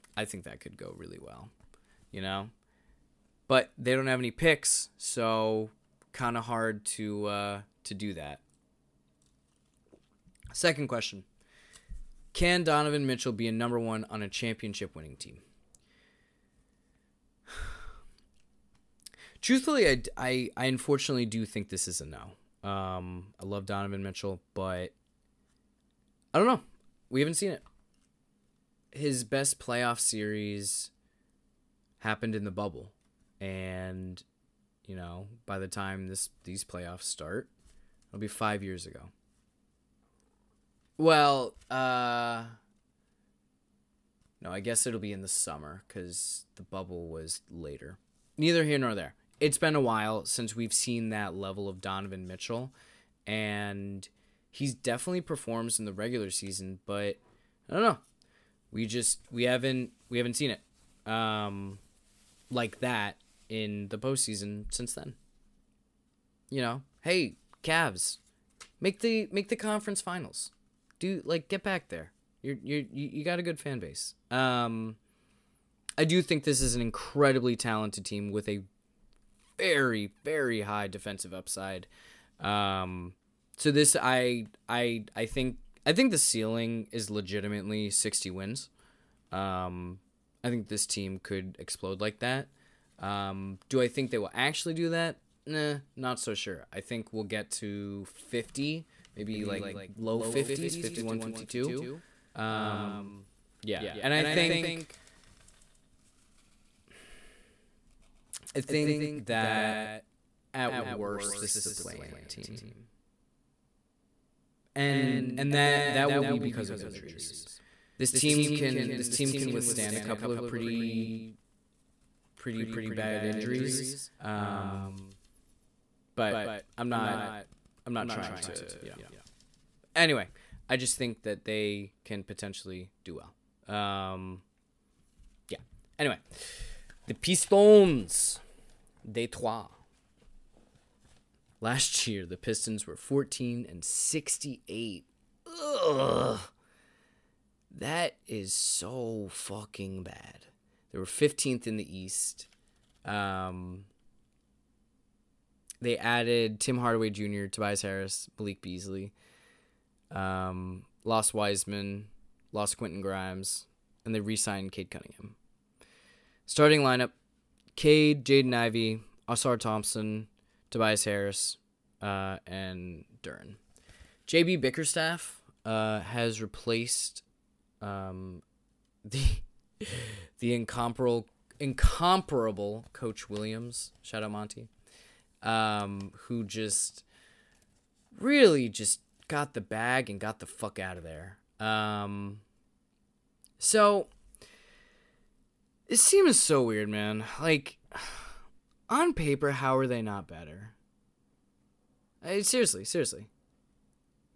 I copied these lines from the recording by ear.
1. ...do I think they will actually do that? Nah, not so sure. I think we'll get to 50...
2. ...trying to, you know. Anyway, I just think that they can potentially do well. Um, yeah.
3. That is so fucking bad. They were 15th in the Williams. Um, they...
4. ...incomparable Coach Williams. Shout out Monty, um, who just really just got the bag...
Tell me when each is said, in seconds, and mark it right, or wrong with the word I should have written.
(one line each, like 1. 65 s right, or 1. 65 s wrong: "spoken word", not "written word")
1. 93 s right
2. 128 s right
3. 147 s wrong: "East", not "Williams"
4. 181 s right.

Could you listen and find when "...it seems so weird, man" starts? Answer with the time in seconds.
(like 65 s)
195 s.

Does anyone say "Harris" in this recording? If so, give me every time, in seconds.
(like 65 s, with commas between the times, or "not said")
157 s, 171 s.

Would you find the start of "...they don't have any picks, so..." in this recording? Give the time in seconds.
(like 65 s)
3 s.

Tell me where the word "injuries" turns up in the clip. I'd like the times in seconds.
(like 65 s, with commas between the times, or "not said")
116 s, 123 s.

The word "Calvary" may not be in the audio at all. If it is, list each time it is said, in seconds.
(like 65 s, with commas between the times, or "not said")
not said.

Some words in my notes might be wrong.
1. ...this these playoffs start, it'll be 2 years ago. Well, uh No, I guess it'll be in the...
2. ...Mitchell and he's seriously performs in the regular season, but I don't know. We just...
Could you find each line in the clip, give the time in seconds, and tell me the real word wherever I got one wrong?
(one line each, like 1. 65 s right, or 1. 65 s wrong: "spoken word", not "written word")
1. 36 s wrong: "5", not "2"
2. 52 s wrong: "definitely", not "seriously".